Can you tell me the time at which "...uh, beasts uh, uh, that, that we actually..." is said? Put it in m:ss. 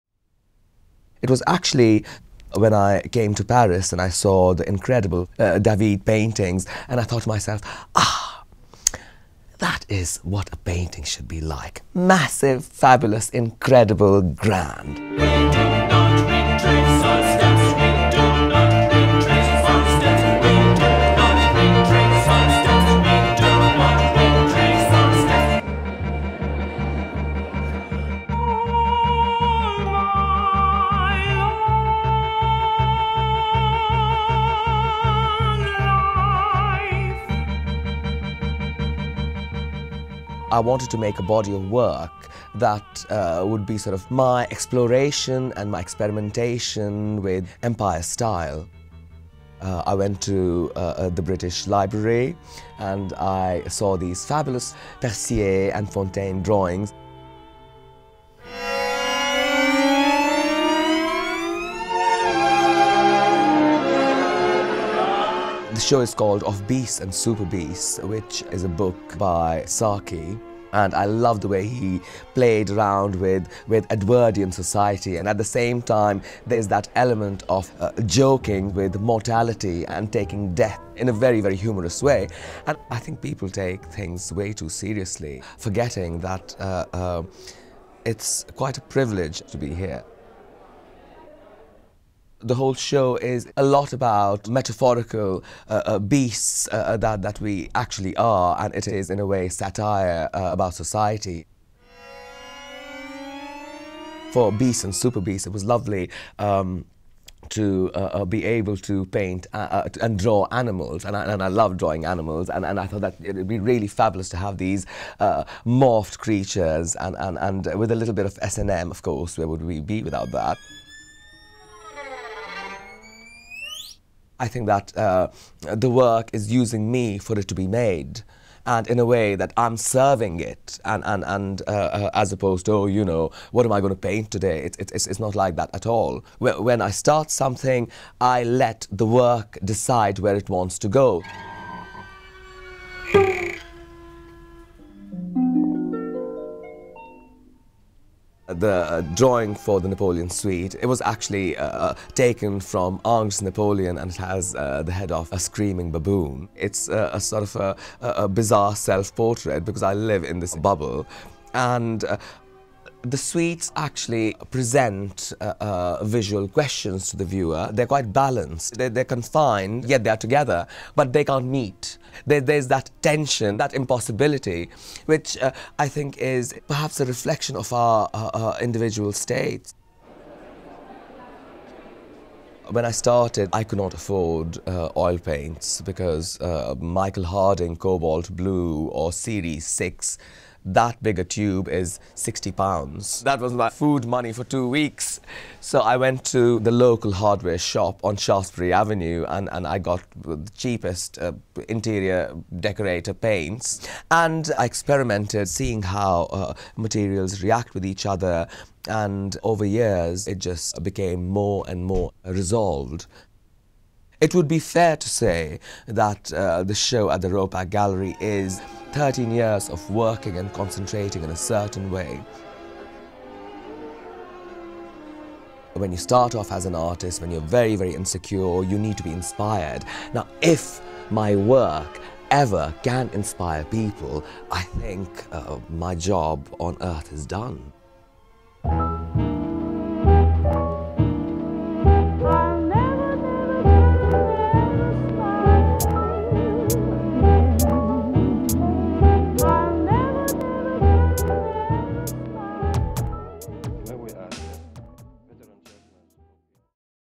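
1:35.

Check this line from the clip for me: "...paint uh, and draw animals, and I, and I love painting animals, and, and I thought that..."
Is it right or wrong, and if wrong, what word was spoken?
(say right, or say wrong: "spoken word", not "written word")
wrong: "drawing", not "painting".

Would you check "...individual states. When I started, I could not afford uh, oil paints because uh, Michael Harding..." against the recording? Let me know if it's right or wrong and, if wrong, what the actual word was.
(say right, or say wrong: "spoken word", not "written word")
right.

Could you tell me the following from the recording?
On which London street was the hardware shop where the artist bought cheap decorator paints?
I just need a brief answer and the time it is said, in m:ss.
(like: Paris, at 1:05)
Shaftesbury Avenue, at 3:18.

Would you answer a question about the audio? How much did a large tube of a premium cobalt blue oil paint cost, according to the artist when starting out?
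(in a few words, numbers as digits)
60 pounds.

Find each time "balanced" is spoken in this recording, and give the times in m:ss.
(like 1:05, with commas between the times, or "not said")
2:48.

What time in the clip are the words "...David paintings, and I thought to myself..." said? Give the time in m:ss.
0:05.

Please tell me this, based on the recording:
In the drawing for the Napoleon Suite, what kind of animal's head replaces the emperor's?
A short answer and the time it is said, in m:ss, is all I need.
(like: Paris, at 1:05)
screaming baboon, at 2:35.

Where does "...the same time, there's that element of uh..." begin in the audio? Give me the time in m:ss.
1:15.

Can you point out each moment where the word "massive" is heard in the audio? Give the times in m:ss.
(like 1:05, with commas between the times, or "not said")
0:11.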